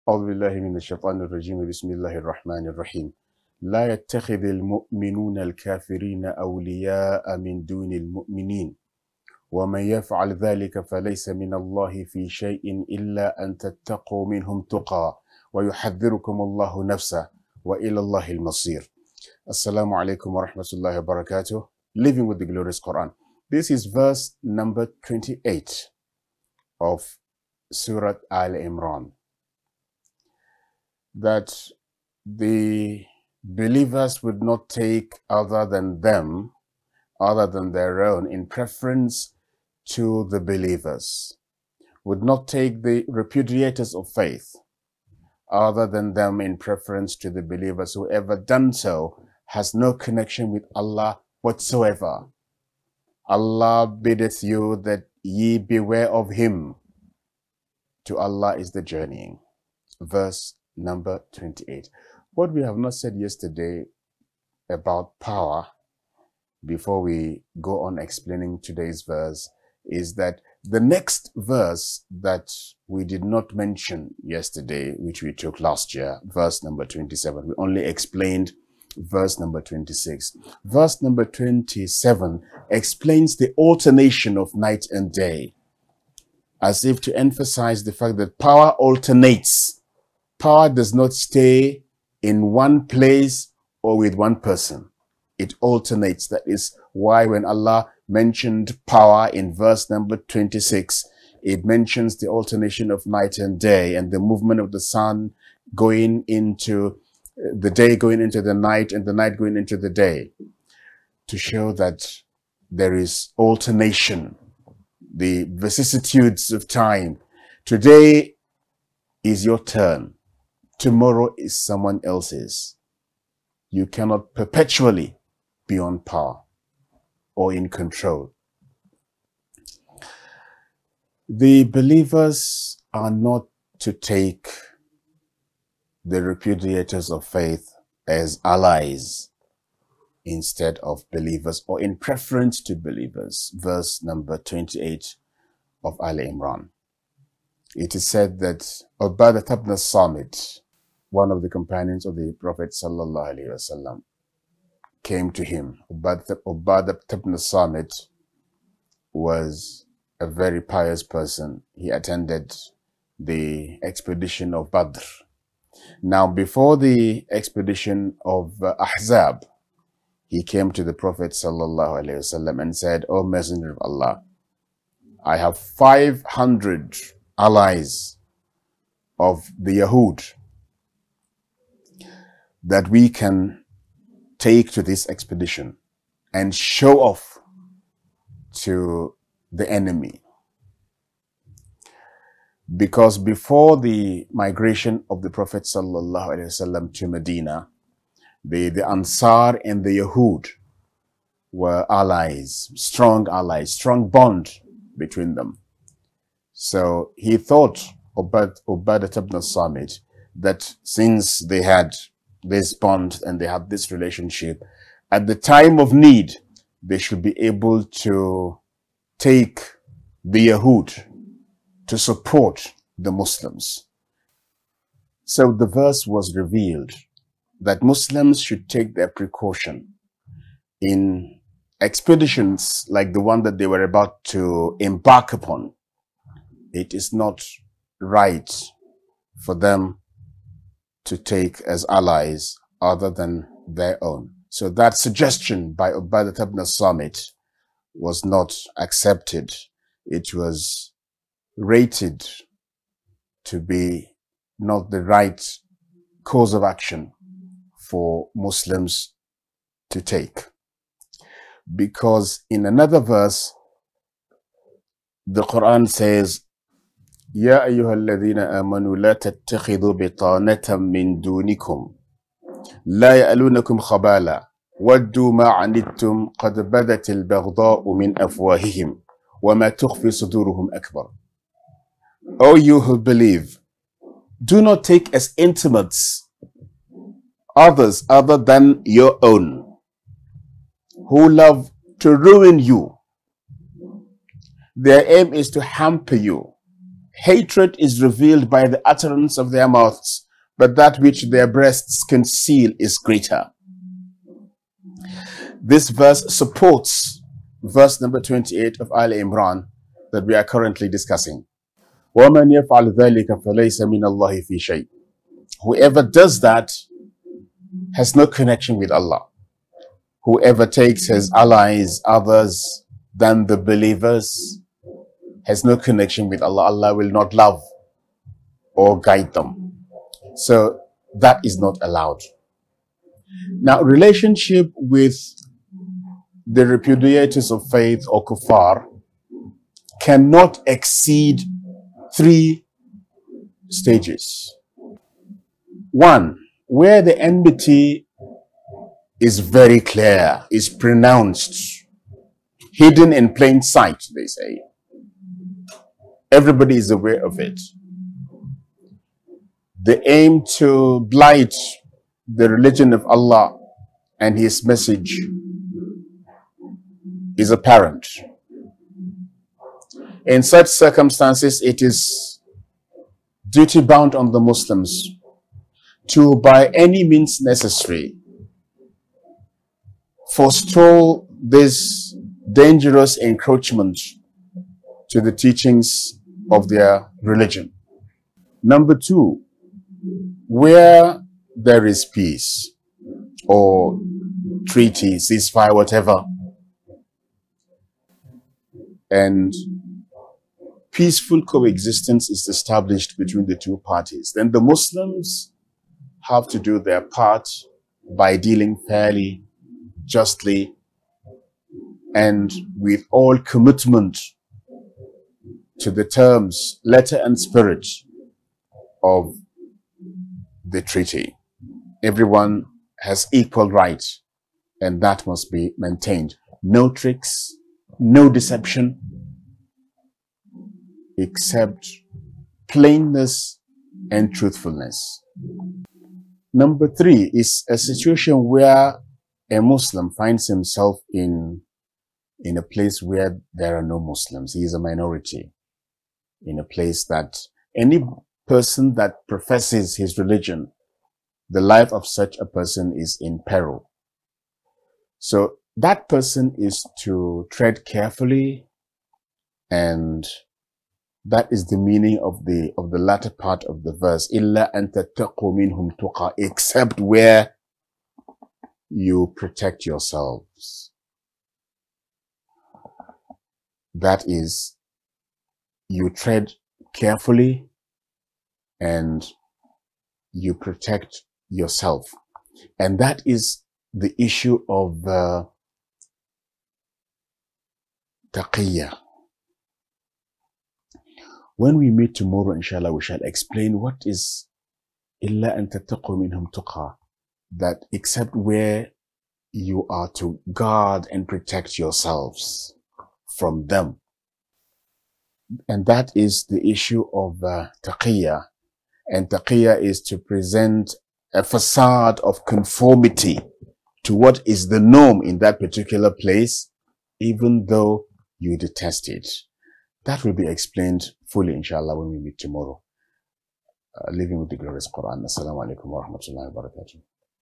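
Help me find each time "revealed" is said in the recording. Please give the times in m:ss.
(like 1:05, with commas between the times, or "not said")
3:46, 4:58.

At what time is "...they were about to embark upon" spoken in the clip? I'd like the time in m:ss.
3:53.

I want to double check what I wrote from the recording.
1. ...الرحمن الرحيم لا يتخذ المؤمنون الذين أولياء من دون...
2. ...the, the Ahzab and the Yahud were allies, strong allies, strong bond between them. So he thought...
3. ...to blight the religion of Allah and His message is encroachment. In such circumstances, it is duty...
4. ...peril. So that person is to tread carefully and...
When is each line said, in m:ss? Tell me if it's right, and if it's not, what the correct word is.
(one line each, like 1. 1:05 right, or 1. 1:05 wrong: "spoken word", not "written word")
1. 0:02 wrong: "الكافرين", not "الذين"
2. 3:18 wrong: "Ansar", not "Ahzab"
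3. 6:00 wrong: "apparent", not "encroachment"
4. 7:33 right.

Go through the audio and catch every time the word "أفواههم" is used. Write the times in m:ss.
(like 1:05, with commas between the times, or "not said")
4:38.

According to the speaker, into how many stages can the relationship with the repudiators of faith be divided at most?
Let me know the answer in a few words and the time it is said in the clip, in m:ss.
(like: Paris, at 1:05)
3, at 5:42.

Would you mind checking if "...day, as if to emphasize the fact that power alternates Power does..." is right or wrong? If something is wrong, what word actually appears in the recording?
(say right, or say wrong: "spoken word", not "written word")
right.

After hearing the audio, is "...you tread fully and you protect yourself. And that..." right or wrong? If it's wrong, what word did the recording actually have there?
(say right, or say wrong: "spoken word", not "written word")
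wrong: "carefully", not "fully".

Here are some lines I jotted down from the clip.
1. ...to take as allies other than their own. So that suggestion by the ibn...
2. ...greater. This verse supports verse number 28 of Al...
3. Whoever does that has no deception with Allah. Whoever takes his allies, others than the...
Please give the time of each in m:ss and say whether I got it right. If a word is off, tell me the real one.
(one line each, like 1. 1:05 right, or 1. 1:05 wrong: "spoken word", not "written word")
1. 4:01 right
2. 5:02 right
3. 5:12 wrong: "connection", not "deception".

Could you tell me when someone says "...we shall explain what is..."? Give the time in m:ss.
8:12.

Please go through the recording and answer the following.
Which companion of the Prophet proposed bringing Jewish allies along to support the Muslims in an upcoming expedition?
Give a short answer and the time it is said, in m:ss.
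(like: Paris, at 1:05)
Ubadah ibn Samit, at 2:35.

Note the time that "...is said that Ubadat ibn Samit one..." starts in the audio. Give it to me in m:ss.
2:27.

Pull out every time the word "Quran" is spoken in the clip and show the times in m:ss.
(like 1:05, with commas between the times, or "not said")
0:22, 4:25, 8:44.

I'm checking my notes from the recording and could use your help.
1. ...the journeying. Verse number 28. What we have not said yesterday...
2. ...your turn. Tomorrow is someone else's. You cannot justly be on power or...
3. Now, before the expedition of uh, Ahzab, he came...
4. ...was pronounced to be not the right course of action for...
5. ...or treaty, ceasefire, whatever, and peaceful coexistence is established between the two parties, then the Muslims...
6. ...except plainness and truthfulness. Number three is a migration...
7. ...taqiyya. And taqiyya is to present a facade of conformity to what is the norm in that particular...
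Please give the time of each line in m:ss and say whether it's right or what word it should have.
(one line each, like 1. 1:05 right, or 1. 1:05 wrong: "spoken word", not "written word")
1. 0:58 right
2. 1:59 wrong: "perpetually", not "justly"
3. 2:46 right
4. 4:10 wrong: "rated", not "pronounced"
5. 6:33 right
6. 7:11 wrong: "situation", not "migration"
7. 8:27 right.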